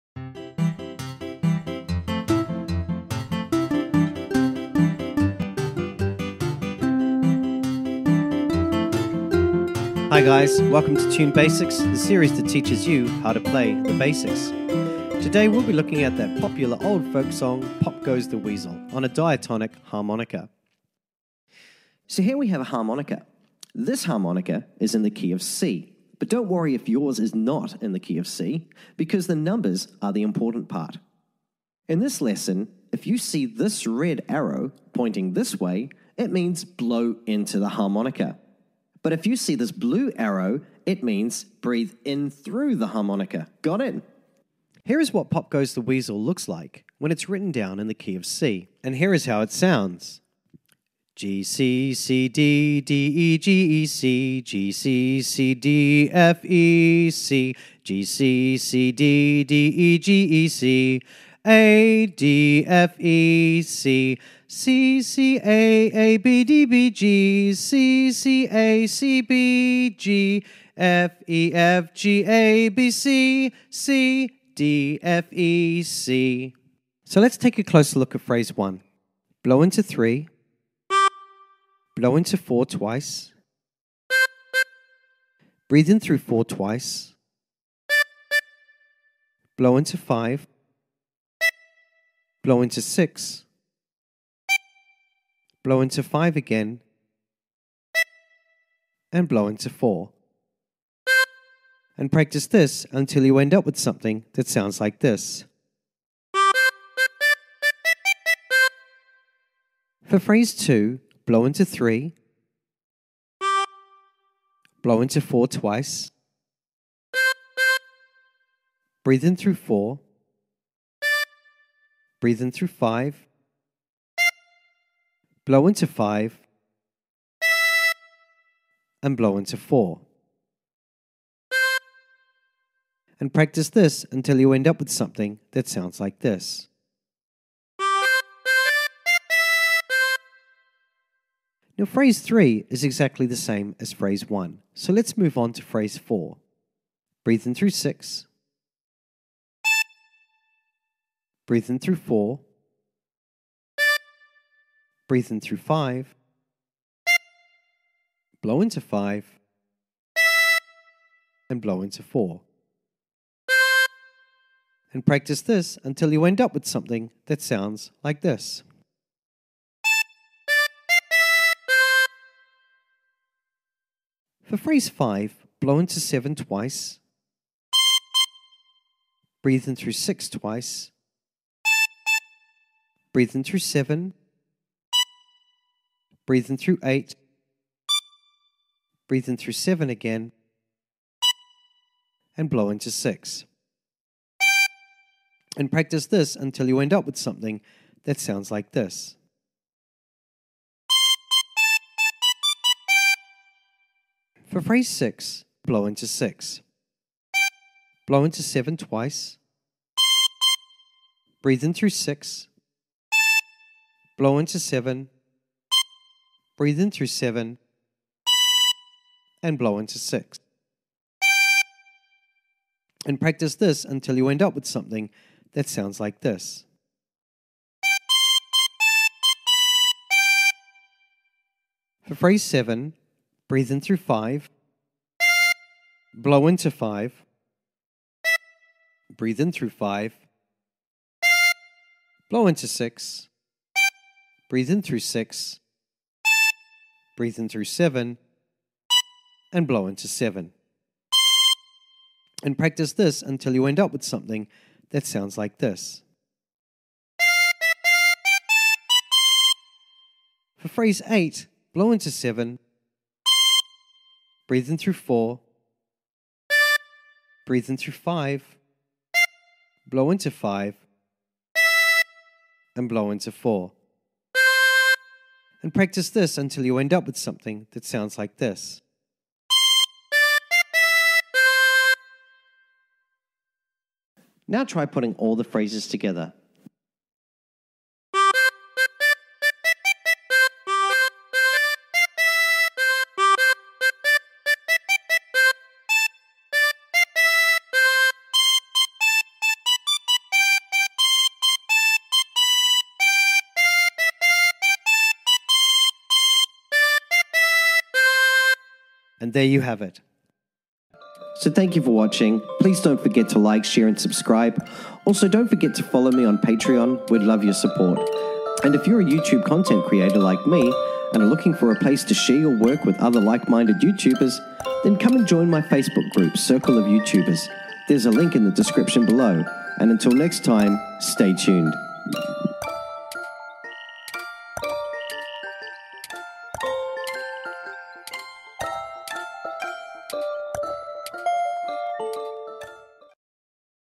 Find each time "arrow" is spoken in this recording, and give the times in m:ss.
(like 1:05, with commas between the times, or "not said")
0:34, 0:40.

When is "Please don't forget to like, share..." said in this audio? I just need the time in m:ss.
5:12.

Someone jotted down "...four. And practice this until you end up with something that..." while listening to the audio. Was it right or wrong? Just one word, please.
right.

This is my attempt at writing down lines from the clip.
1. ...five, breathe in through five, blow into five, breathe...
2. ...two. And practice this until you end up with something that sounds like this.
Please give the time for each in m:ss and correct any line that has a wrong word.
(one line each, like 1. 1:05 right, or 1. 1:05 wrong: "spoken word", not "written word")
1. 3:52 wrong: "seven", not "five"
2. 4:10 wrong: "seven", not "two".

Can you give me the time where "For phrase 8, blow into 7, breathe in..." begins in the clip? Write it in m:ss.
4:20.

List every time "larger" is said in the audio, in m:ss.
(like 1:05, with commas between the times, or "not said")
not said.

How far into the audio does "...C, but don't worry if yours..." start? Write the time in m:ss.
0:25.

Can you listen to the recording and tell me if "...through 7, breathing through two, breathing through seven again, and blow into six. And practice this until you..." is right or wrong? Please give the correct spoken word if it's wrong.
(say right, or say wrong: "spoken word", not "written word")
wrong: "eight", not "two".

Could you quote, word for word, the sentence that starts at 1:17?
So let's take a closer look at phrase one.